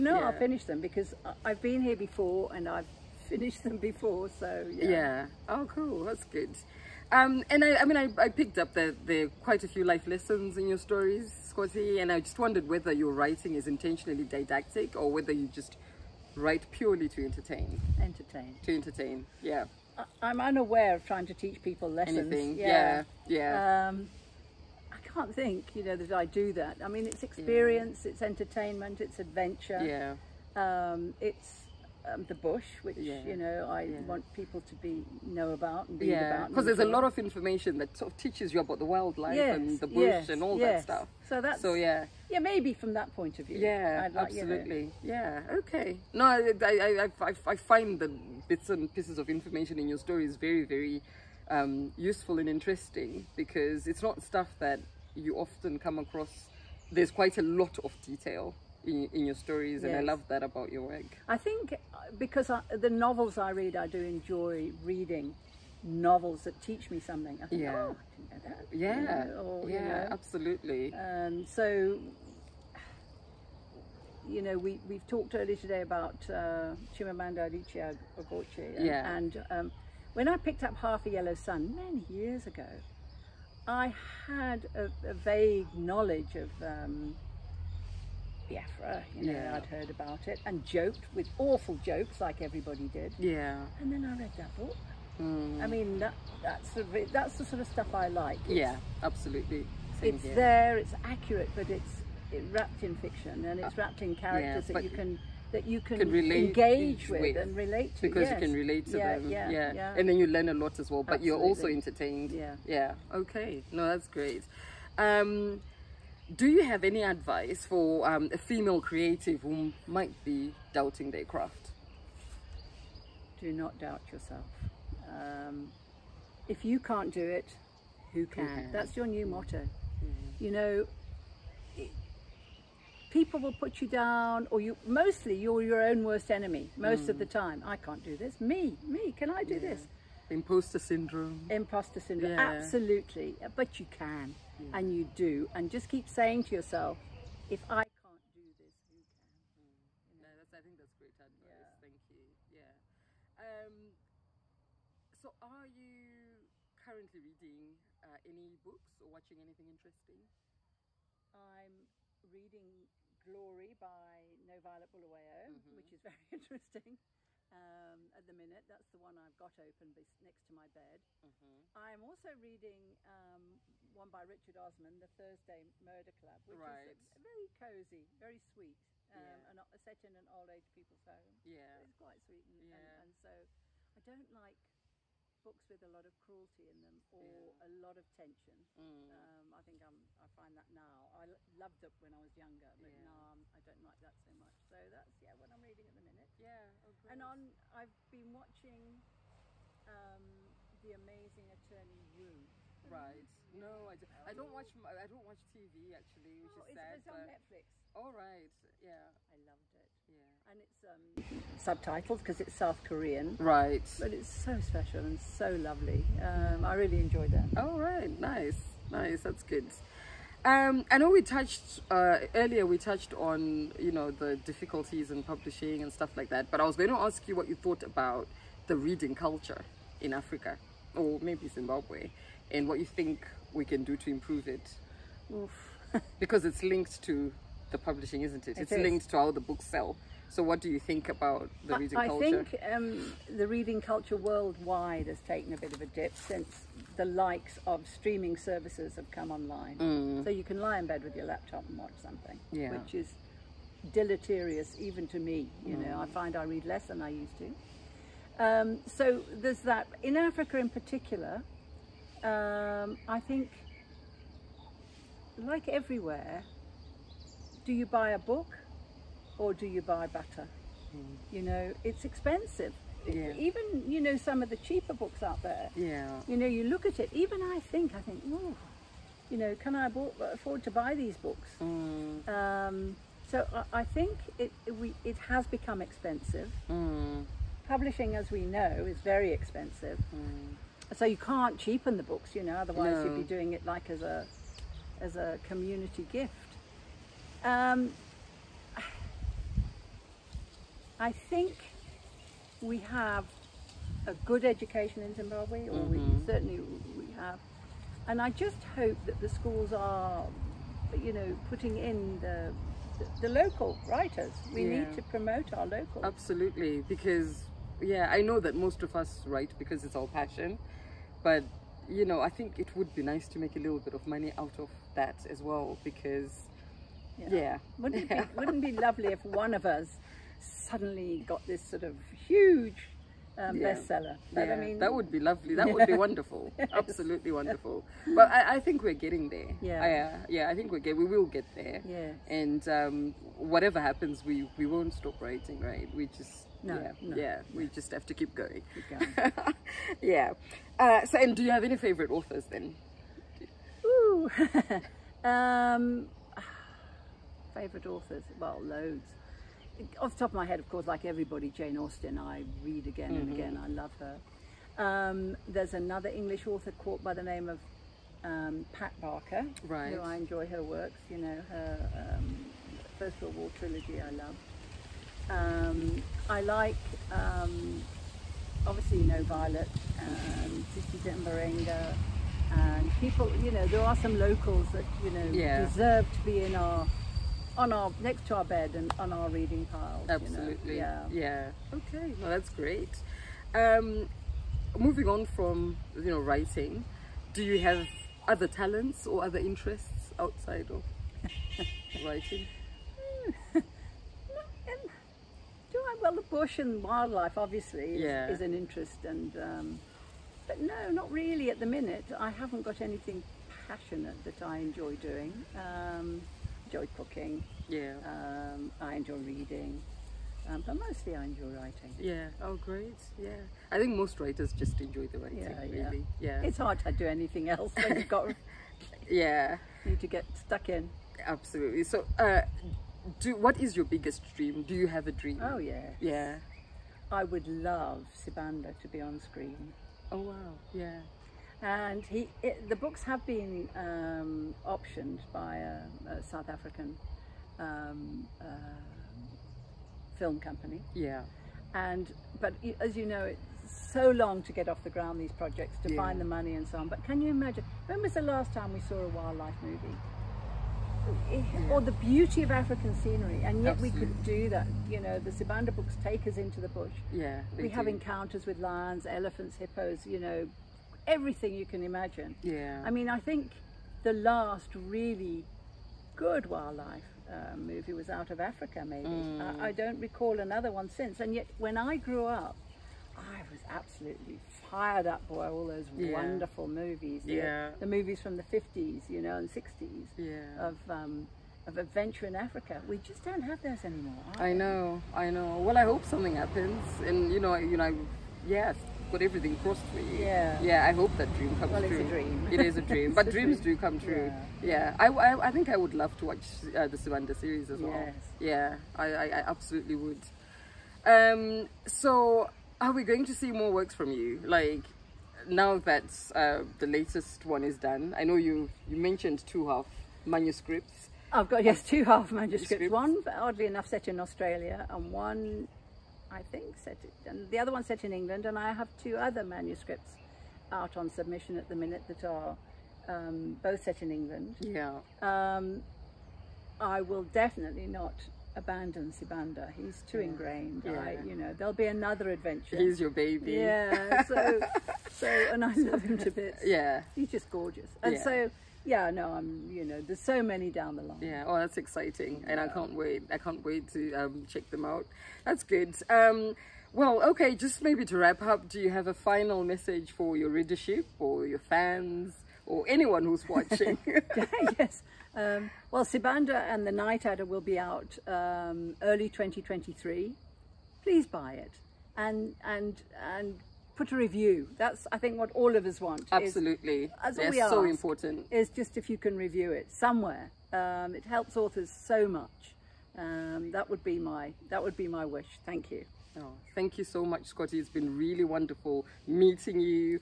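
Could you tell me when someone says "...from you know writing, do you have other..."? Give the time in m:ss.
6:35.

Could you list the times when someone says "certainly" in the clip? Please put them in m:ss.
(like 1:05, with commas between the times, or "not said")
5:06.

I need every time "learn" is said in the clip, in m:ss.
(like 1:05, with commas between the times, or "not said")
1:50.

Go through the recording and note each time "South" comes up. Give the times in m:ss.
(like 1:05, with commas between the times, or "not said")
3:32, 7:26.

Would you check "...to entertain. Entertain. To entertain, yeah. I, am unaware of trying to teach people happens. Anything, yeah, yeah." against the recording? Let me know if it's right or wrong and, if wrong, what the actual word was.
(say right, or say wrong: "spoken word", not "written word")
wrong: "lessons", not "happens".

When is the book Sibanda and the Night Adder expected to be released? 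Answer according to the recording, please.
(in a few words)
early 2023.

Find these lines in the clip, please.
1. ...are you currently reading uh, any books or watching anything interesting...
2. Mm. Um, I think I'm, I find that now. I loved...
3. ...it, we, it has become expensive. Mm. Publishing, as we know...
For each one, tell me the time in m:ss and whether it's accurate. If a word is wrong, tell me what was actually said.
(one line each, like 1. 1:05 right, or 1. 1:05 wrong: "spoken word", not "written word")
1. 2:35 right
2. 3:08 right
3. 4:44 right.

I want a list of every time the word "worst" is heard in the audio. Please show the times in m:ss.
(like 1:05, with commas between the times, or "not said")
2:16.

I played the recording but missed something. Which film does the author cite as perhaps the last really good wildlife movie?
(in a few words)
Out of Africa.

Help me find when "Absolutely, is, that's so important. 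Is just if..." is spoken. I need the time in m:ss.
9:36.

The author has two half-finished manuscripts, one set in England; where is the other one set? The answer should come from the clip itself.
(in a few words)
Australia.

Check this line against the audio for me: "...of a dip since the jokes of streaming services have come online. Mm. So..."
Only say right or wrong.
wrong.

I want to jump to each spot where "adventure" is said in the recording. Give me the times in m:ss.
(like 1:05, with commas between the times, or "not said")
0:29, 8:11, 9:02.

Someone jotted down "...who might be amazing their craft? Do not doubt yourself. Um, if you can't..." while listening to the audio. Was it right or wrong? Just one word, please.
wrong.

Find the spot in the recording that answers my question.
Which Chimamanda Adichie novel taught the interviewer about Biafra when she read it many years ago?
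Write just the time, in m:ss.
1:20.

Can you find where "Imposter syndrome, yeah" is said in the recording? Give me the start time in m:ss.
2:21.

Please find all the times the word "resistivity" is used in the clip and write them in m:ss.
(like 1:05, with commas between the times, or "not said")
not said.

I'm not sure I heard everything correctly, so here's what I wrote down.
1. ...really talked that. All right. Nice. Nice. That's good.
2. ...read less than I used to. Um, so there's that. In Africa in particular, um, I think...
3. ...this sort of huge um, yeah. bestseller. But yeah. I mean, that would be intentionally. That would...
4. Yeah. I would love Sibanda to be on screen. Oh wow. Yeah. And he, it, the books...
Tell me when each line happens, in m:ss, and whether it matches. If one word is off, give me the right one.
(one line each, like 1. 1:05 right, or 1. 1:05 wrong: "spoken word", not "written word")
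1. 3:36 wrong: "enjoyed", not "talked"
2. 4:16 right
3. 5:31 wrong: "lovely", not "intentionally"
4. 7:15 right.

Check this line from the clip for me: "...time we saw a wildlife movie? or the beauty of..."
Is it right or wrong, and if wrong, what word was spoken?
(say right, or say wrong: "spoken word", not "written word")
right.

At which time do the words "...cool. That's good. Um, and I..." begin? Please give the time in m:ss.
0:05.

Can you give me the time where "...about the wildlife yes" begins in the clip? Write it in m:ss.
0:38.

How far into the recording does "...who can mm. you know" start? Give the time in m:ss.
2:28.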